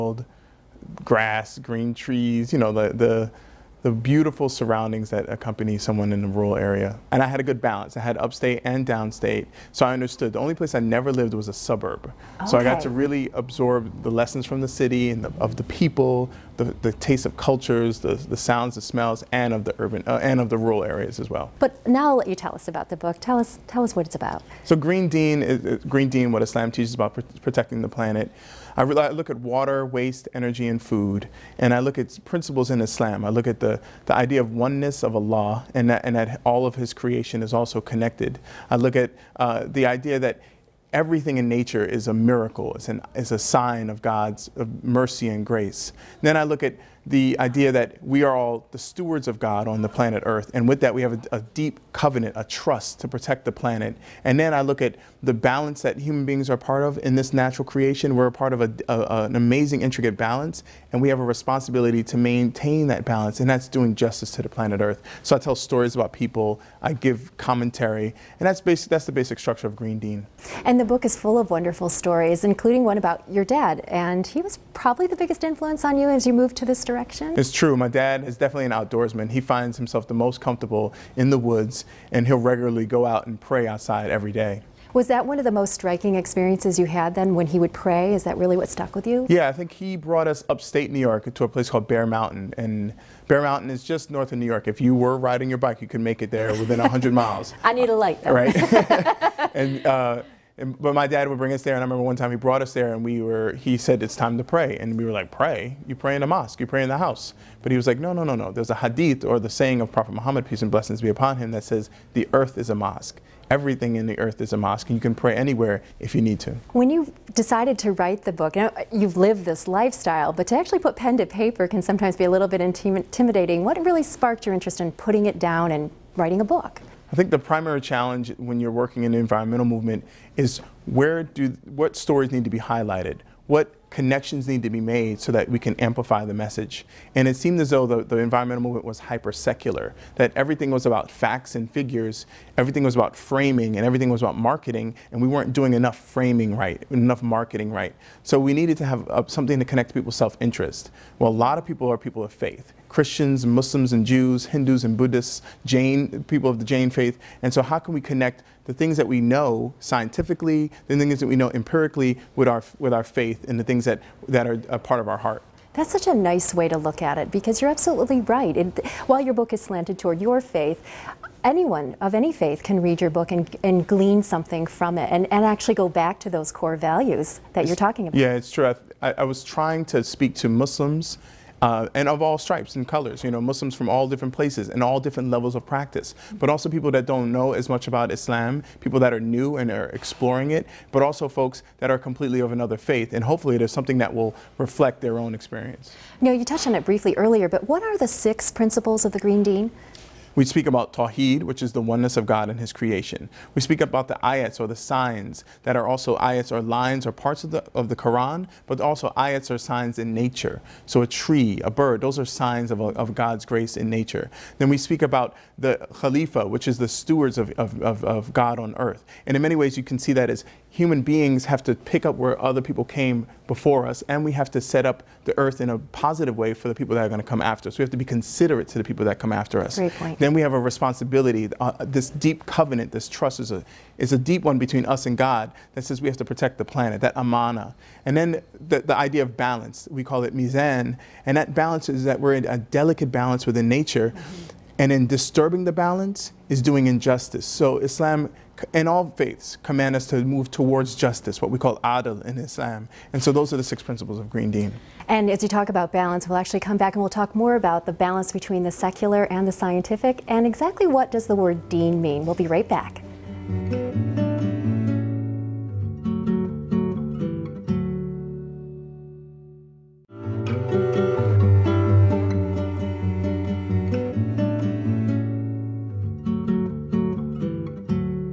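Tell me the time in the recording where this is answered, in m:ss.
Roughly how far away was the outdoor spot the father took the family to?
1:36.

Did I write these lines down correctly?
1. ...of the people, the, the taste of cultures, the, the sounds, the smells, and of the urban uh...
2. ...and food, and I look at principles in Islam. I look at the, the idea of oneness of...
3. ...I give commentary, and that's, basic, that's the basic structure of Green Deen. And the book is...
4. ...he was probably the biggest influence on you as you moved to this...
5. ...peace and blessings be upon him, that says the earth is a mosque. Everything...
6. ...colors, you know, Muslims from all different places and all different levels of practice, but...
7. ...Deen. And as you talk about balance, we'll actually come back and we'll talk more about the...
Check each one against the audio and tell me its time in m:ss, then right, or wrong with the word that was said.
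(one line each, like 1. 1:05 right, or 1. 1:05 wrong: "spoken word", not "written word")
1. 0:15 right
2. 0:30 right
3. 1:06 right
4. 1:14 right
5. 1:50 right
6. 3:02 right
7. 4:14 right.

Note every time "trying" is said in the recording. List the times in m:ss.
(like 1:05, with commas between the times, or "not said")
2:59.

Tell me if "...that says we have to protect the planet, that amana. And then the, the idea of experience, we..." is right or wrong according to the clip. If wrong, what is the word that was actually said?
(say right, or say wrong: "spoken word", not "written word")
wrong: "balance", not "experience".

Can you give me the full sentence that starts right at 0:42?
It's, an, it's a sign of God's of mercy and grace.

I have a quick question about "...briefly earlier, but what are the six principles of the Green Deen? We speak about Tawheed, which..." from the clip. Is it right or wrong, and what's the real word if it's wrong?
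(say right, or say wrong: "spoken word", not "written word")
right.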